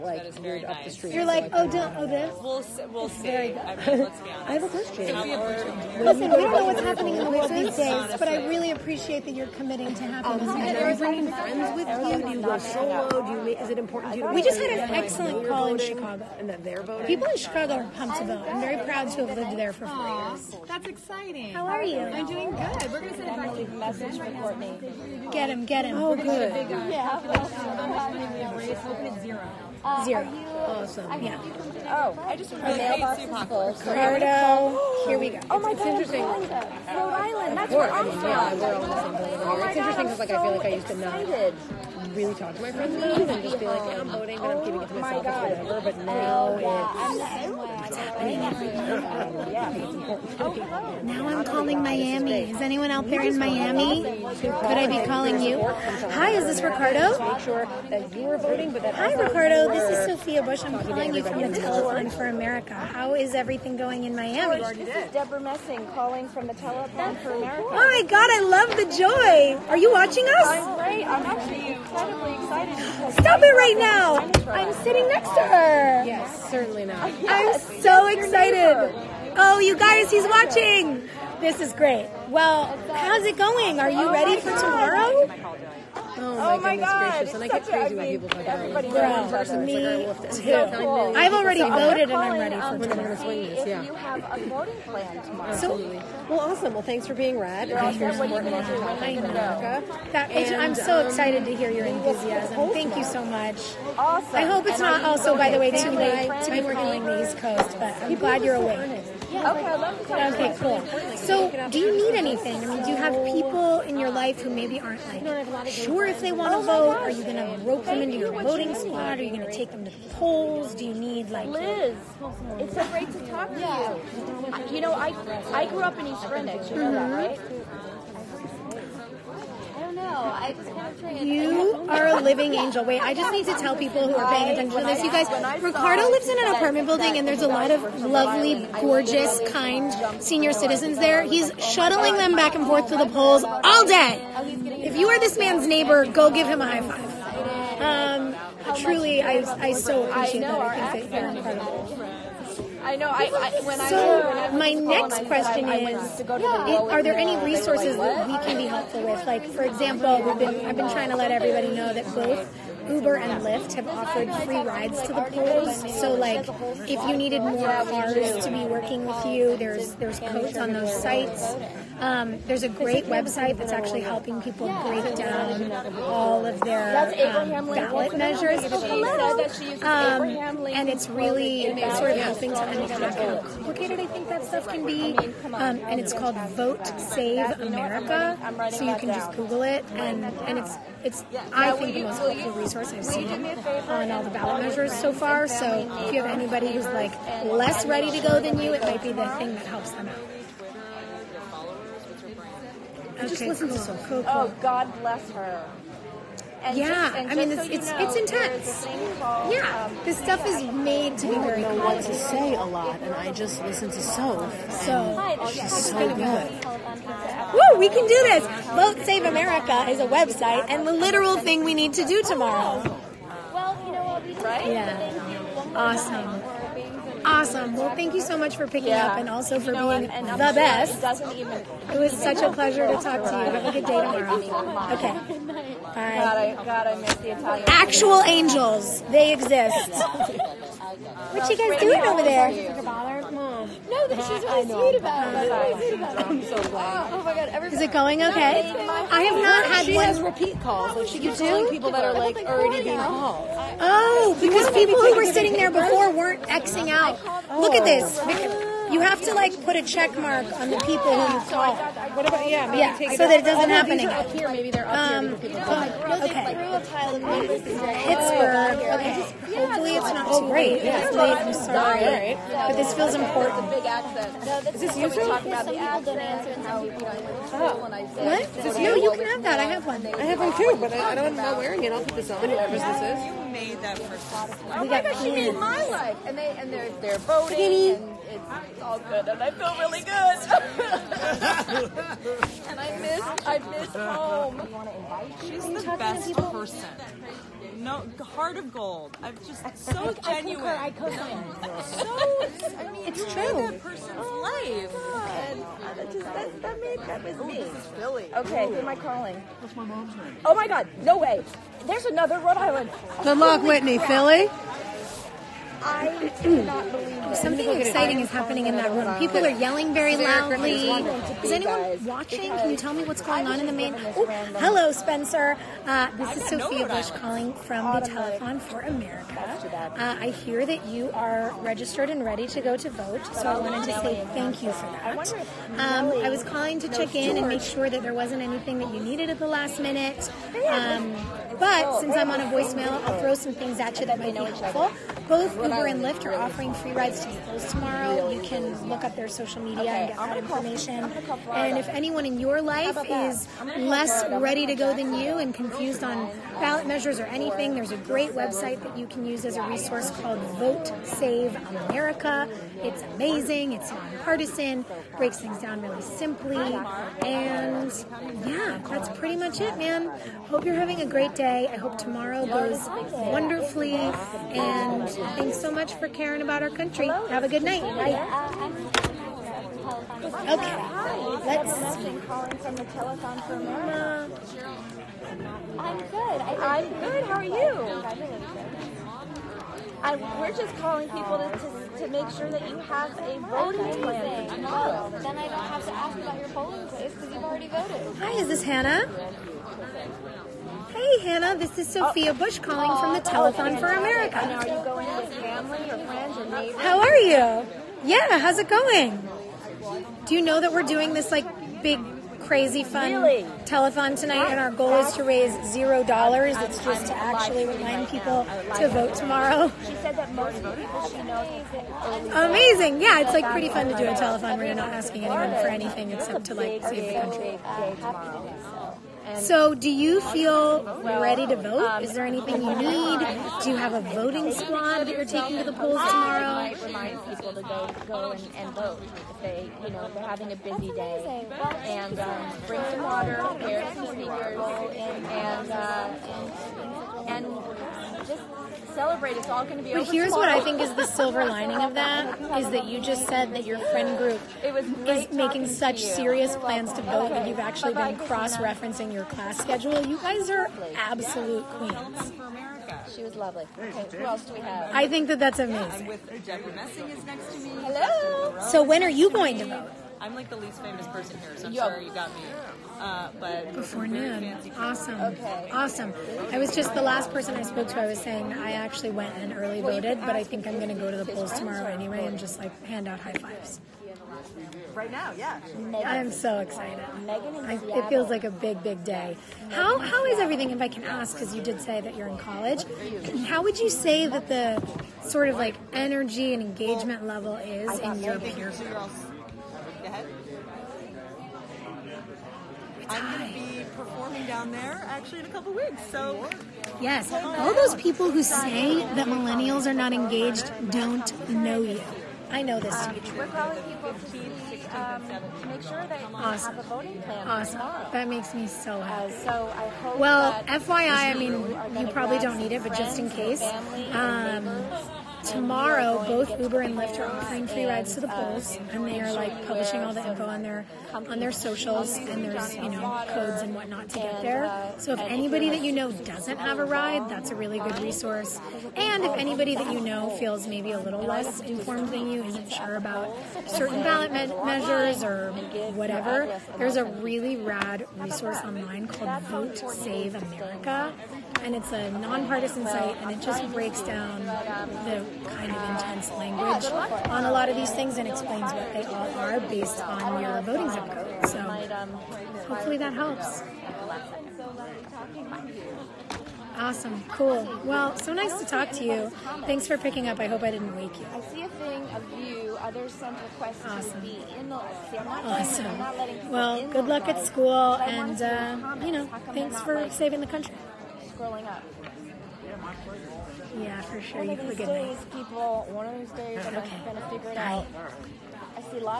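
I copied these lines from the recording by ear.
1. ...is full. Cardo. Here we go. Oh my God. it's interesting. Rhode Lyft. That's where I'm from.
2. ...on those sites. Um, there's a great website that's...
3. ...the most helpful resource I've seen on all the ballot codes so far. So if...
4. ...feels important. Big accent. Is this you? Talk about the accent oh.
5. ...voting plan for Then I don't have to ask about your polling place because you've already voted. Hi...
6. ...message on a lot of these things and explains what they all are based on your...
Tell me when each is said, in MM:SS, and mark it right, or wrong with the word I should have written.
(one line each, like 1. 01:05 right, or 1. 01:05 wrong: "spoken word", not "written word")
1. 00:33 wrong: "Island", not "Lyft"
2. 02:50 right
3. 03:11 wrong: "measures", not "codes"
4. 04:32 right
5. 06:33 right
6. 09:16 wrong: "language", not "message".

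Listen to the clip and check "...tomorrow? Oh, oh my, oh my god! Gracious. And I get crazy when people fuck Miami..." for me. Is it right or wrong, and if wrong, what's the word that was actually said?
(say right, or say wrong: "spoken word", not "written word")
wrong: "Everybody", not "Miami".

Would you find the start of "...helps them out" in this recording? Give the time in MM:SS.
03:19.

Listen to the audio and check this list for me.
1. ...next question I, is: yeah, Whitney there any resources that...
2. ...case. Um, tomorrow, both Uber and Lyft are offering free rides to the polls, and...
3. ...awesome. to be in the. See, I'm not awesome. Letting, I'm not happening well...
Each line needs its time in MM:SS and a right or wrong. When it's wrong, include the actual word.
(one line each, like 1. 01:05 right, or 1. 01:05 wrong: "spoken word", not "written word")
1. 02:34 wrong: "Are", not "Whitney"
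2. 08:43 right
3. 09:33 wrong: "letting", not "happening".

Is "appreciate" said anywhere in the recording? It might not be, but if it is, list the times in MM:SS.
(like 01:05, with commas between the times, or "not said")
00:08, 02:30.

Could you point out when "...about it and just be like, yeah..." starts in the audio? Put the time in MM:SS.
00:42.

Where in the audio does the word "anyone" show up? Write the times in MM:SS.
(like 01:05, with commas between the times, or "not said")
00:52, 05:21, 05:51, 07:05.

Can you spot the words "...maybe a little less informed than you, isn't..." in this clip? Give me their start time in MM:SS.
09:00.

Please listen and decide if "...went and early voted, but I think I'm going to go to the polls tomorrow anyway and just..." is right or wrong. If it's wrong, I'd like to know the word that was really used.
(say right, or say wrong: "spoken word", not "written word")
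right.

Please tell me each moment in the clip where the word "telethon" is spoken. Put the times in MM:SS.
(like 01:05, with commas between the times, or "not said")
01:01, 01:06, 05:28, 06:22, 06:43, 06:53, 07:04.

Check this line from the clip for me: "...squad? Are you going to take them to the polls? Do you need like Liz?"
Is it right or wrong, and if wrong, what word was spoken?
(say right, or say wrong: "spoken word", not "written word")
right.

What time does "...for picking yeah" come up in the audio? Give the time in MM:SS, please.
03:48.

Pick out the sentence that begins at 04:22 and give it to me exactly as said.
Maybe yeah, so that it doesn't oh, happen again.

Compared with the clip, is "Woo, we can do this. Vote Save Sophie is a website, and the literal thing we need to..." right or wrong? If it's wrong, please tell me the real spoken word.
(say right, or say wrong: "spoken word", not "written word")
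wrong: "America", not "Sophie".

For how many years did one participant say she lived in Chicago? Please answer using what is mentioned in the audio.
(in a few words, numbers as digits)
4.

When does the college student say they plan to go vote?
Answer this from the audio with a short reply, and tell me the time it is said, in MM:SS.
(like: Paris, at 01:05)
Before noon, at 07:53.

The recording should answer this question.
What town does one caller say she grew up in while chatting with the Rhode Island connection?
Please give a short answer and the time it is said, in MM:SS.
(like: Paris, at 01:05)
East Greenwich, at 02:06.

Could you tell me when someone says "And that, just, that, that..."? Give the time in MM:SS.
05:05.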